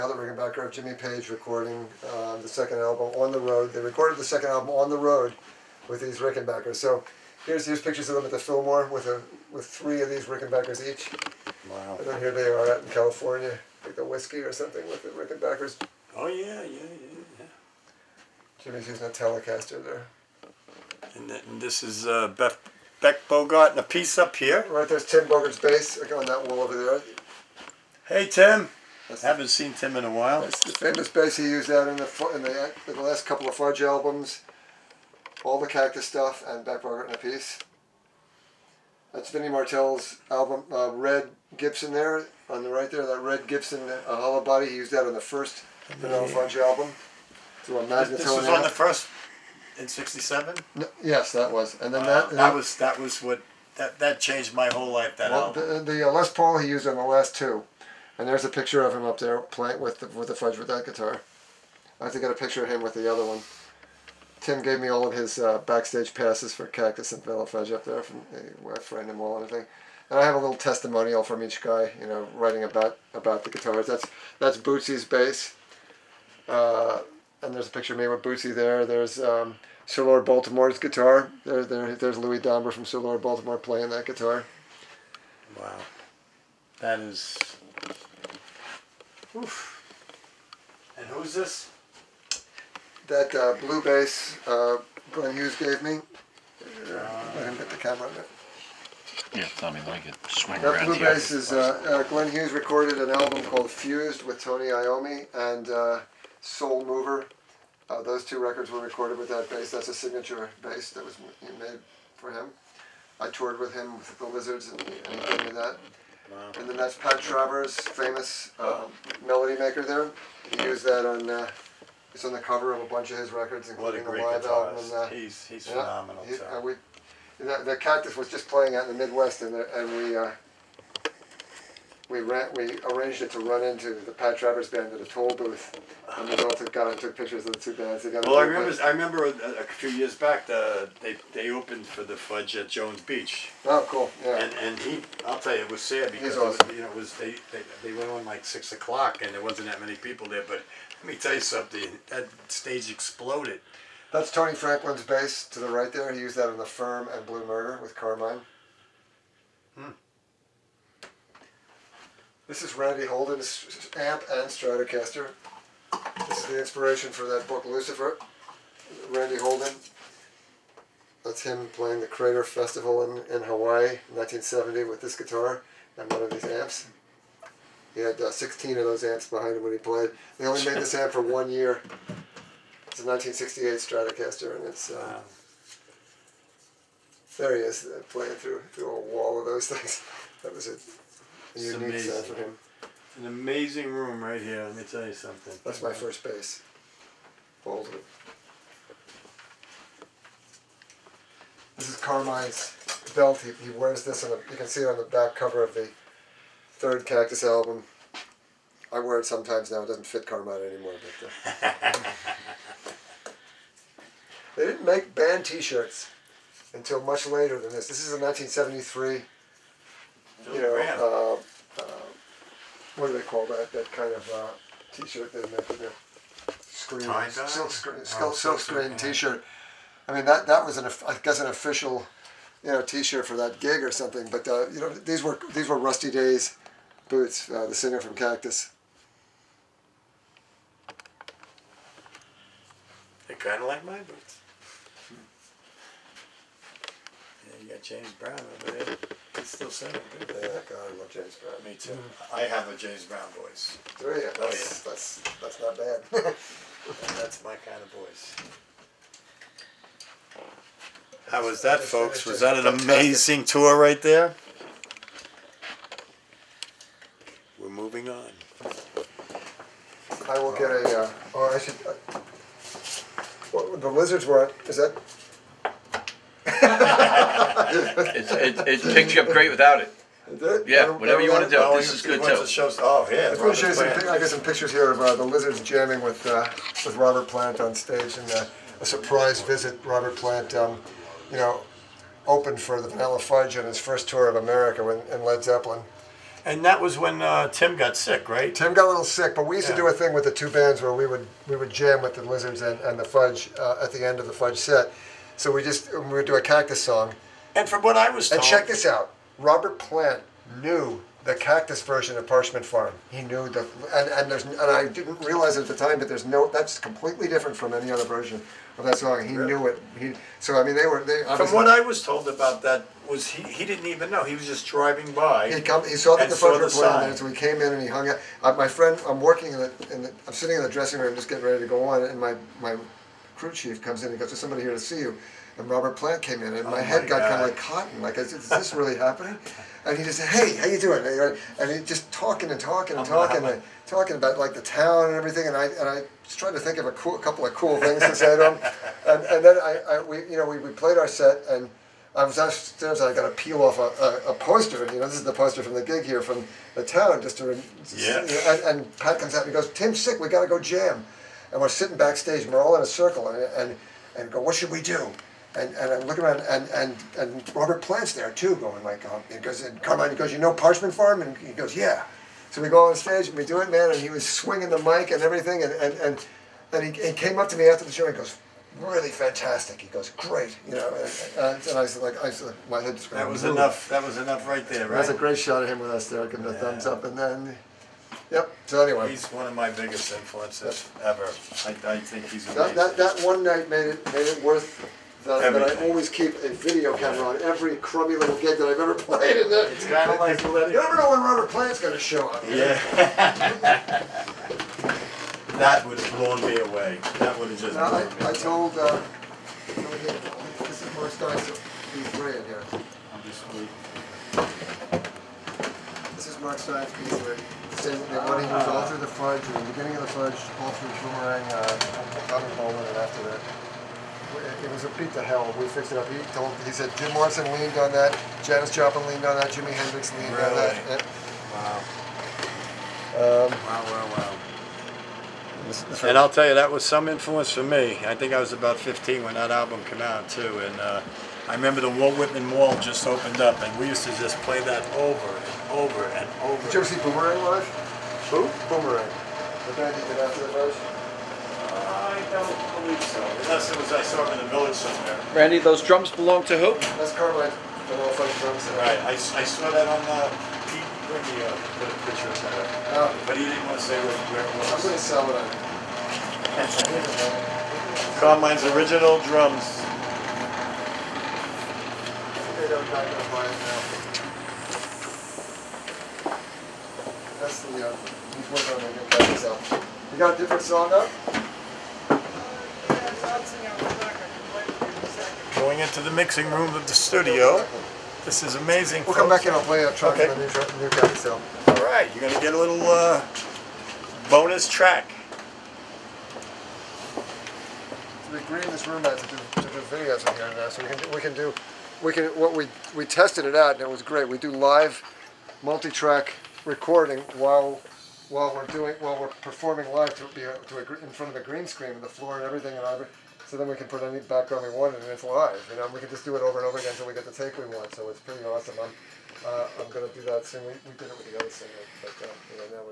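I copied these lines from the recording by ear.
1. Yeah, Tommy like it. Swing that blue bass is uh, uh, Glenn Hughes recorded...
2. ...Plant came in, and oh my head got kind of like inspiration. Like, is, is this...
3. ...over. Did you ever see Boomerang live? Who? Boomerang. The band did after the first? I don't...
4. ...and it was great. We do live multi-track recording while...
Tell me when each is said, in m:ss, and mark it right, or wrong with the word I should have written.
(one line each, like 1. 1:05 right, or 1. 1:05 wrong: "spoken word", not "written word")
1. 1:39 right
2. 5:35 wrong: "cotton", not "inspiration"
3. 7:26 right
4. 8:23 right.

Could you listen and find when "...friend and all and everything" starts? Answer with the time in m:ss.
1:08.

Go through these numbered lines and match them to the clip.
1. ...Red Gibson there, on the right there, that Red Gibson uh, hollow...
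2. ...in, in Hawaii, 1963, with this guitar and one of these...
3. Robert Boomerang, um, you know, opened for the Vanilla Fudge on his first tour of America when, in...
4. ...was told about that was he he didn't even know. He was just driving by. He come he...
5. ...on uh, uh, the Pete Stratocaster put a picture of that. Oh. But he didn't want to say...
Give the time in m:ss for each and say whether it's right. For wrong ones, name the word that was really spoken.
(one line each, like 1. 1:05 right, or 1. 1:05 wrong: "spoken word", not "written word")
1. 0:40 right
2. 2:53 wrong: "1970", not "1963"
3. 4:49 wrong: "Plant", not "Boomerang"
4. 5:21 right
5. 7:39 wrong: "Ringy", not "Stratocaster".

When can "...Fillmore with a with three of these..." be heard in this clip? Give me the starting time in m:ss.
0:08.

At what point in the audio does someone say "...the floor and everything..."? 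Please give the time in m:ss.
8:32.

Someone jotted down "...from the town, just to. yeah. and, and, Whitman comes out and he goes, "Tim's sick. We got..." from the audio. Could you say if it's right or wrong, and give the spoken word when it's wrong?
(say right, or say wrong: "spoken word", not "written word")
wrong: "Pat", not "Whitman".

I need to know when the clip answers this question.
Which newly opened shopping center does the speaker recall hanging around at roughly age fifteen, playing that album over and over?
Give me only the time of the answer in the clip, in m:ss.
7:21.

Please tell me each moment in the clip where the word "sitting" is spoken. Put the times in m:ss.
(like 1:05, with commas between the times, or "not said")
5:30, 6:01.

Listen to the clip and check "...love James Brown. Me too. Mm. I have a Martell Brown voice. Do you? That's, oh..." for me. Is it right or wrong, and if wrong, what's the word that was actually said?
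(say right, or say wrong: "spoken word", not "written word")
wrong: "James", not "Martell".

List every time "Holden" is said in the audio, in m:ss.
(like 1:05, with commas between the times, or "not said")
2:43, 2:49.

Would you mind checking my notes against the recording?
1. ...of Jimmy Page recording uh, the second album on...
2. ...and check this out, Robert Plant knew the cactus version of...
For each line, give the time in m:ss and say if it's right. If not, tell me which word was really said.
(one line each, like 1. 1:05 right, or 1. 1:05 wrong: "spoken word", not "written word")
1. 0:00 right
2. 5:08 right.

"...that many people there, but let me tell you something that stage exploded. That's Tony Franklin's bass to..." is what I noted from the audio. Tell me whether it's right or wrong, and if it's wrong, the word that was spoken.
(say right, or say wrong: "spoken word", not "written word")
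right.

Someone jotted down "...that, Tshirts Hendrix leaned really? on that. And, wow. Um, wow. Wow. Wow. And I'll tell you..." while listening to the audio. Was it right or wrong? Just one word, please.
wrong.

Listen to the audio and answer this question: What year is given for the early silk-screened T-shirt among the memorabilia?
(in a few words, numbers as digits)
1973.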